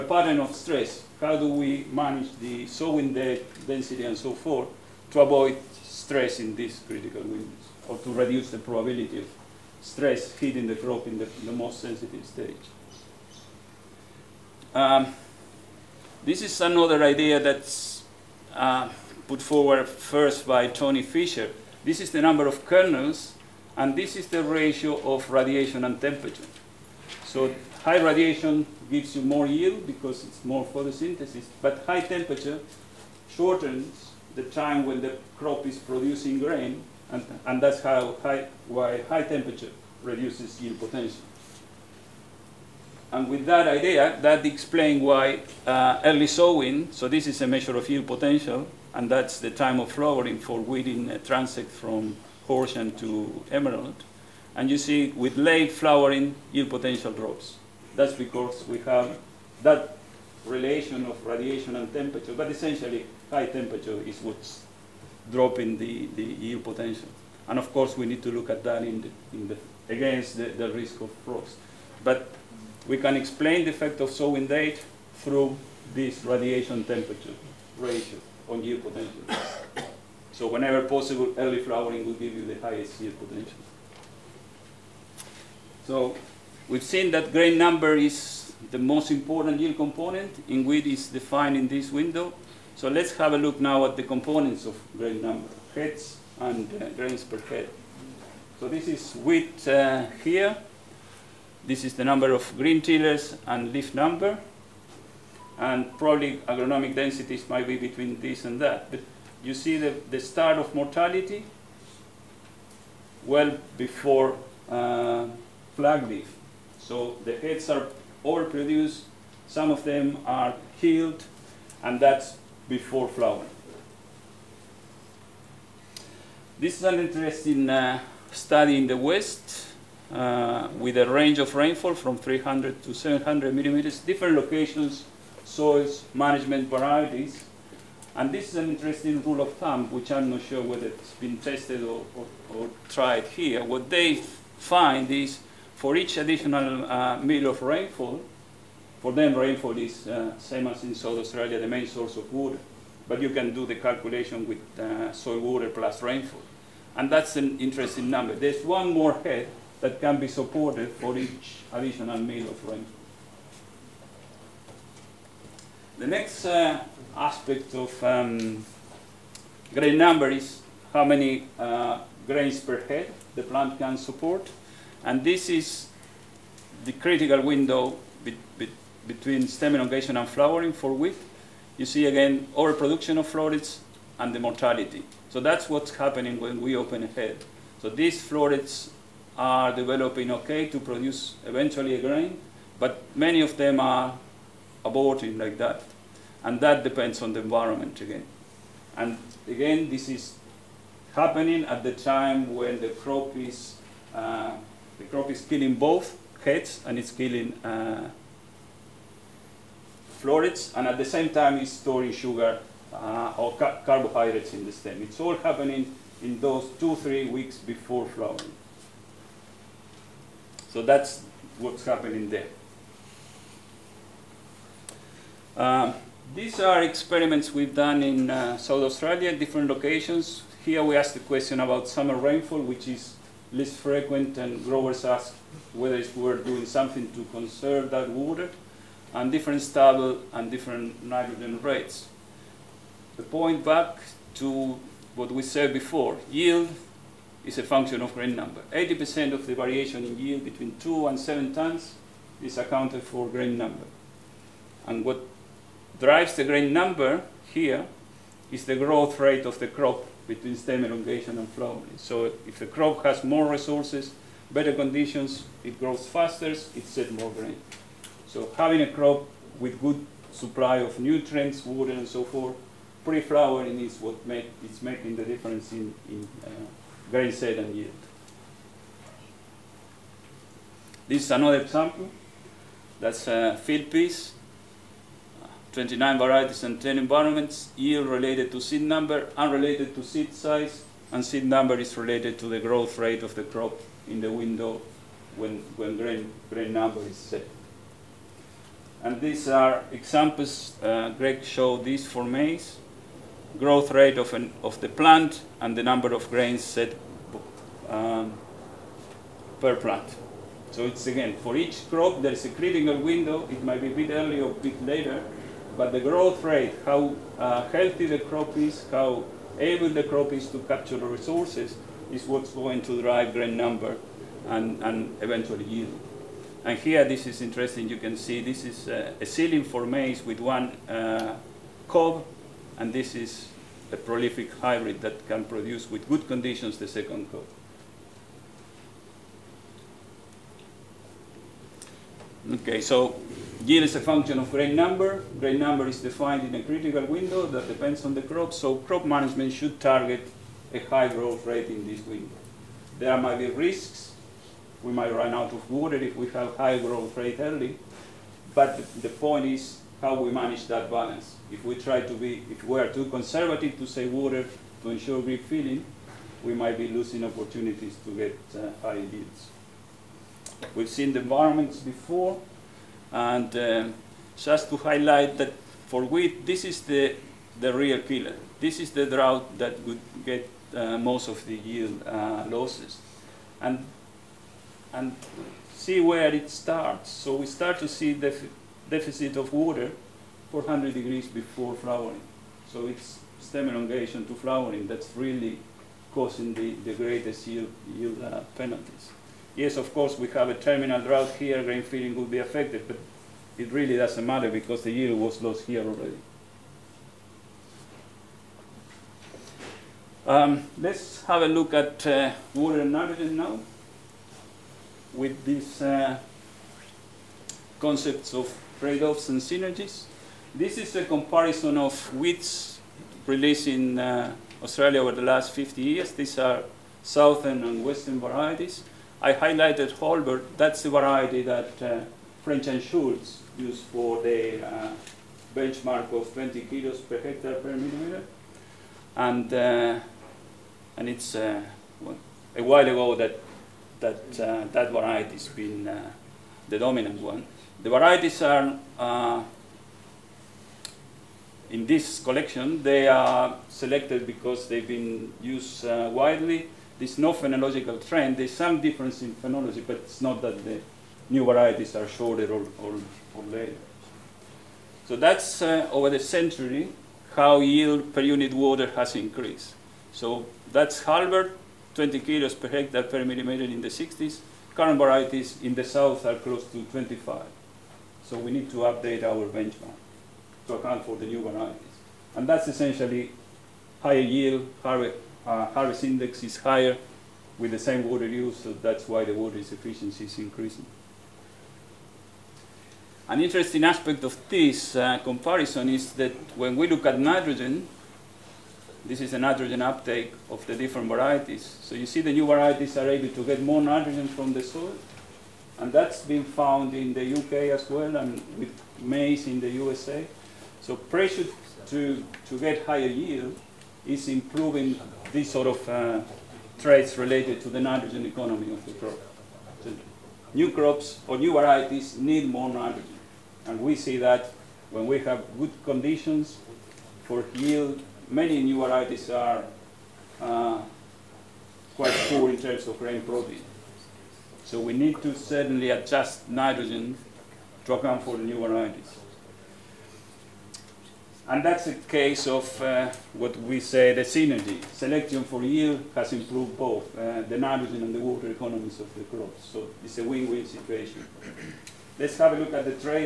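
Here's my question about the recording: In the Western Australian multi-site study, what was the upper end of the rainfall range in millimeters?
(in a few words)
700.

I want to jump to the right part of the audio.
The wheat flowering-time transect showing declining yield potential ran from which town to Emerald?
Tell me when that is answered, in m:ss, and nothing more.
0:52.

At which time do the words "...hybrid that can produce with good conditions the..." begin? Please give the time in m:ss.
5:34.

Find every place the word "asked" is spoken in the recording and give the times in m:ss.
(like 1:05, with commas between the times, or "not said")
3:50, 3:55.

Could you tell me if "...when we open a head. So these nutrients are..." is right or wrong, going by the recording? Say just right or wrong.
wrong.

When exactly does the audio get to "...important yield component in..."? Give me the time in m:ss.
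1:29.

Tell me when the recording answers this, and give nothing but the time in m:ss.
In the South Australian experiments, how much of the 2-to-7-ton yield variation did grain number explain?
4:08.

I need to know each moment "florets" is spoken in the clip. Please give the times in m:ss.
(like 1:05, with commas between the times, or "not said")
3:03, 3:08, 3:30.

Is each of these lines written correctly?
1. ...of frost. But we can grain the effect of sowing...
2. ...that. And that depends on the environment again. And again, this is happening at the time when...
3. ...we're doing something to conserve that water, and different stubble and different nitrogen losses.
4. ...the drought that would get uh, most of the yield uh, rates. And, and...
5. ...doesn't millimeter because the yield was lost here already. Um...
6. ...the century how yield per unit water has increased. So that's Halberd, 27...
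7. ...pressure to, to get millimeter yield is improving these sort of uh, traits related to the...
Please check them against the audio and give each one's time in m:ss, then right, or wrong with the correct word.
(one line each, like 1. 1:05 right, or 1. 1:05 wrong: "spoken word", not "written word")
1. 1:11 wrong: "explain", not "grain"
2. 3:15 right
3. 3:56 wrong: "rates", not "losses"
4. 6:18 wrong: "losses", not "rates"
5. 6:43 wrong: "matter", not "millimeter"
6. 7:46 wrong: "20", not "27"
7. 8:30 wrong: "higher", not "millimeter".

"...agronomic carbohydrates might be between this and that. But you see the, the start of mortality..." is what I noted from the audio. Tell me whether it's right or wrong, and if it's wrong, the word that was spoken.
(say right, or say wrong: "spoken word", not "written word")
wrong: "densities", not "carbohydrates".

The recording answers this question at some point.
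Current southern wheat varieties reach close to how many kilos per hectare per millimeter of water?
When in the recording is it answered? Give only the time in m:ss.
7:56.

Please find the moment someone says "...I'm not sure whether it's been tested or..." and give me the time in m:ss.
2:20.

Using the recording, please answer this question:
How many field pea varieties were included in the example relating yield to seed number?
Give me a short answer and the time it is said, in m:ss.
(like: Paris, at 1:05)
29, at 4:45.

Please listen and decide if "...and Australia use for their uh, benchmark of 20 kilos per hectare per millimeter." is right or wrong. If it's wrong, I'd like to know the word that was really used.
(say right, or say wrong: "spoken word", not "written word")
wrong: "Schultz", not "Australia".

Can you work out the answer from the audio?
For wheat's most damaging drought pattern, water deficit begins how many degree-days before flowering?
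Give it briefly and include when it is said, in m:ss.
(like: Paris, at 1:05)
400, at 6:30.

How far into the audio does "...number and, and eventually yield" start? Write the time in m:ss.
5:23.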